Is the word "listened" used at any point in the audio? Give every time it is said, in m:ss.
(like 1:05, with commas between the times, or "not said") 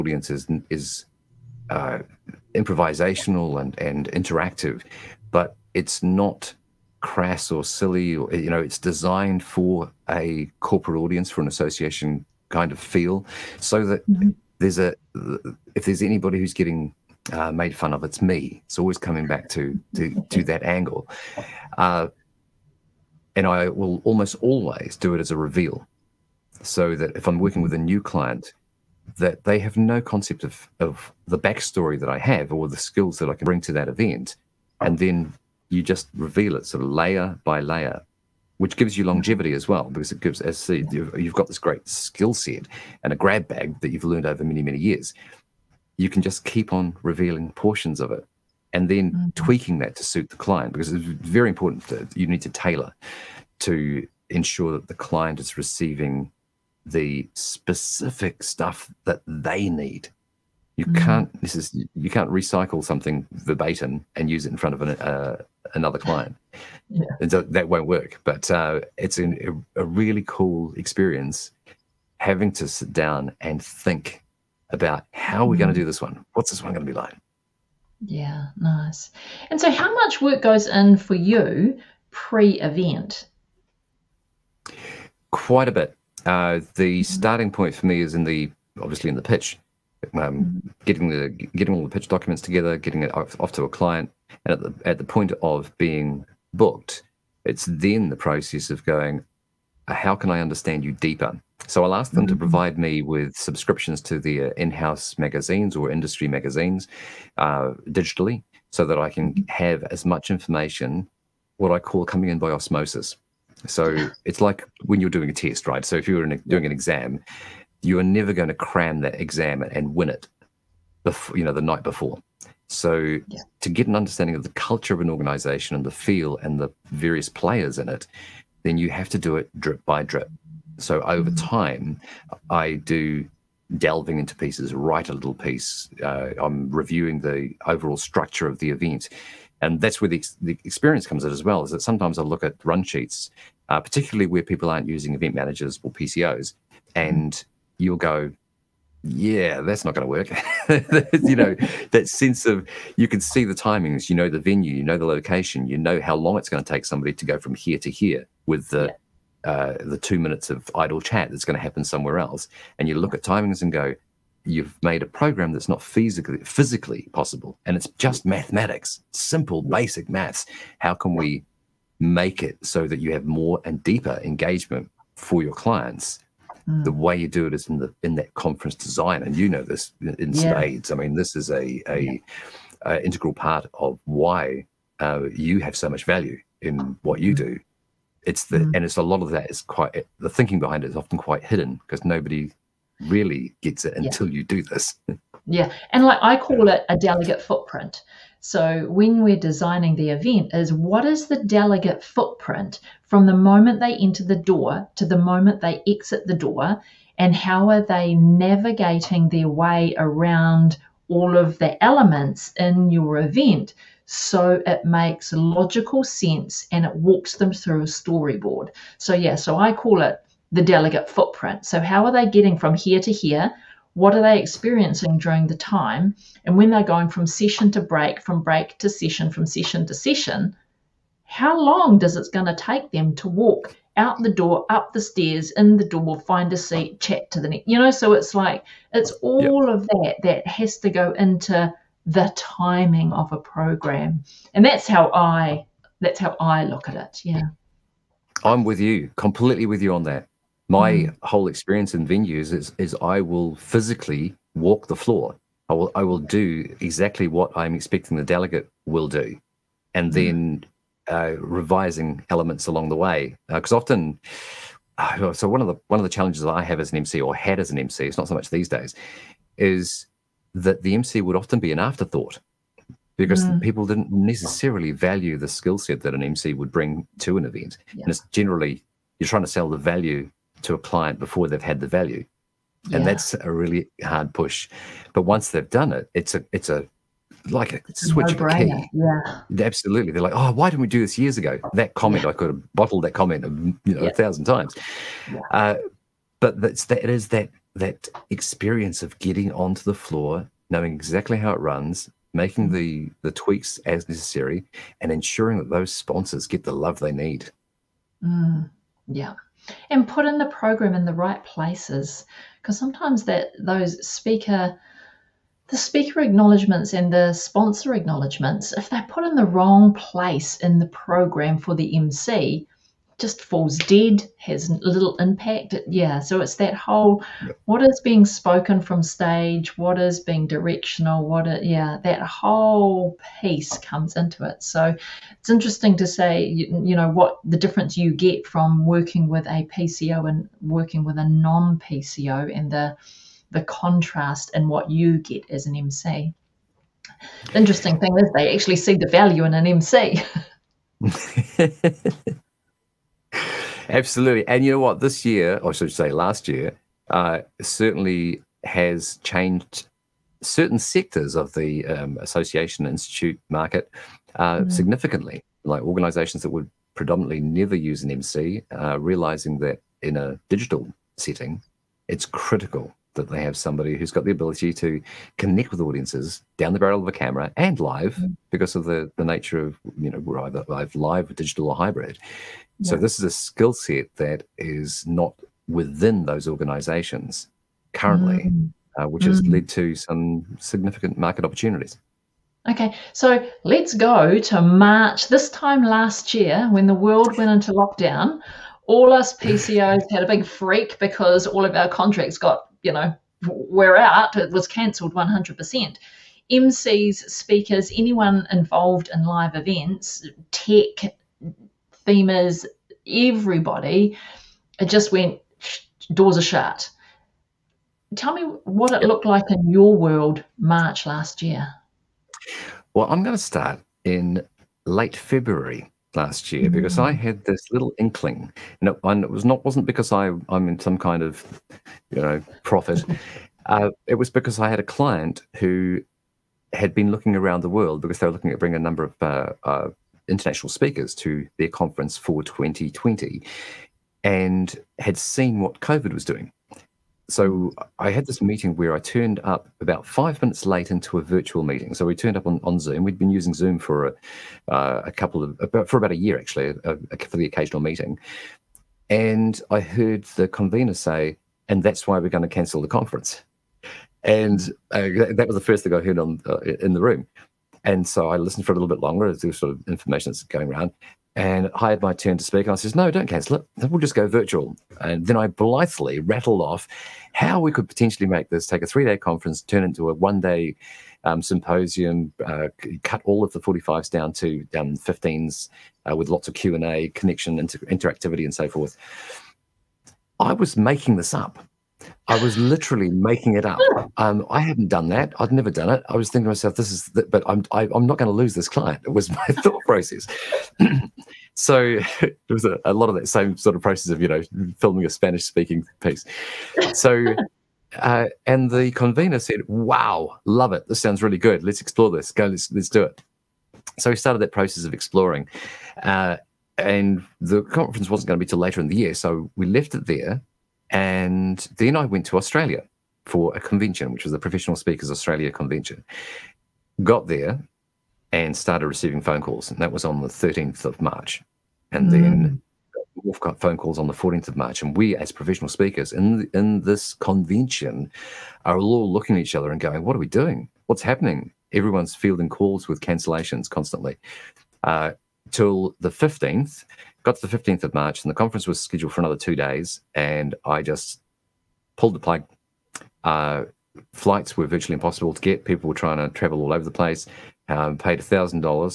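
7:48.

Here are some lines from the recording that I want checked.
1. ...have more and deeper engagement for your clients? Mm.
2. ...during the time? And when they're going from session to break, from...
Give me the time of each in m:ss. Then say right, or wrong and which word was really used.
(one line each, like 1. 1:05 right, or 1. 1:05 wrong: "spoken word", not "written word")
1. 2:53 right
2. 3:45 right.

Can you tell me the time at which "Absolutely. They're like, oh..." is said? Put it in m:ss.
4:49.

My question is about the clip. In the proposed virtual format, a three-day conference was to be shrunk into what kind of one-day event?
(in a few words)
symposium.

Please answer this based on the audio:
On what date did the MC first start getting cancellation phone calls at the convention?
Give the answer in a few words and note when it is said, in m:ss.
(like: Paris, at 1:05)
13th of March, at 8:50.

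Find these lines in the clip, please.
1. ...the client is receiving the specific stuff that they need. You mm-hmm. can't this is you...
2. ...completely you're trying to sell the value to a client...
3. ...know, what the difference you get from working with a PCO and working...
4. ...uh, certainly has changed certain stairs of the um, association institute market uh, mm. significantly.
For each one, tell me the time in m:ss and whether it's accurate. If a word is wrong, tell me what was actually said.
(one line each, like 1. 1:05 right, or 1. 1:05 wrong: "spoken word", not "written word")
1. 0:54 right
2. 4:38 wrong: "generally", not "completely"
3. 5:36 right
4. 5:57 wrong: "sectors", not "stairs".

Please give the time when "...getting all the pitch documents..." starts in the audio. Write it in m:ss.
1:31.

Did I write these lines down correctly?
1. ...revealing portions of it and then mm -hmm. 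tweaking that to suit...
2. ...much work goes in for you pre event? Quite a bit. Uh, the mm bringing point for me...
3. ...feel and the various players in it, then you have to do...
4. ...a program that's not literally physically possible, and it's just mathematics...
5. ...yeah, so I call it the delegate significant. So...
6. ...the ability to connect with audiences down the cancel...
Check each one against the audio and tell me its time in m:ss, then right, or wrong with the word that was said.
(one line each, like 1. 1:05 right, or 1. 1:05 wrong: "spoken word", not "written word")
1. 0:47 right
2. 1:19 wrong: "starting", not "bringing"
3. 2:05 right
4. 2:45 wrong: "physically", not "literally"
5. 3:39 wrong: "footprint", not "significant"
6. 6:14 wrong: "barrel", not "cancel".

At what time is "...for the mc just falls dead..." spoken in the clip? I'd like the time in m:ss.
5:21.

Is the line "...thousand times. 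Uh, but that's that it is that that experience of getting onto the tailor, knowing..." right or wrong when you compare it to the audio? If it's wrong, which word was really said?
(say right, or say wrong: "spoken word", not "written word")
wrong: "floor", not "tailor".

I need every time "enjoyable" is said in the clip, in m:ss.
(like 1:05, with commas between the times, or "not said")
not said.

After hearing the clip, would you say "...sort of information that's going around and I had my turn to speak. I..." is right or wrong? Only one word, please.
right.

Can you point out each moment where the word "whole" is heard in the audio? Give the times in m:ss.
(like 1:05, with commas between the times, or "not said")
4:11, 5:26, 5:32.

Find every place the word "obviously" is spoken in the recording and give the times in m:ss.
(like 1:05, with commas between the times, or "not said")
1:28.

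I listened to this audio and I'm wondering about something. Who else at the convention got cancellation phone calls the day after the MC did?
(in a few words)
Wolf.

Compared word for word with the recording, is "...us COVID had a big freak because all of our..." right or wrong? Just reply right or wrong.
wrong.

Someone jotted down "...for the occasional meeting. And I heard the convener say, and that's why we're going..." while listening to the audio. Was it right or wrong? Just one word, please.
right.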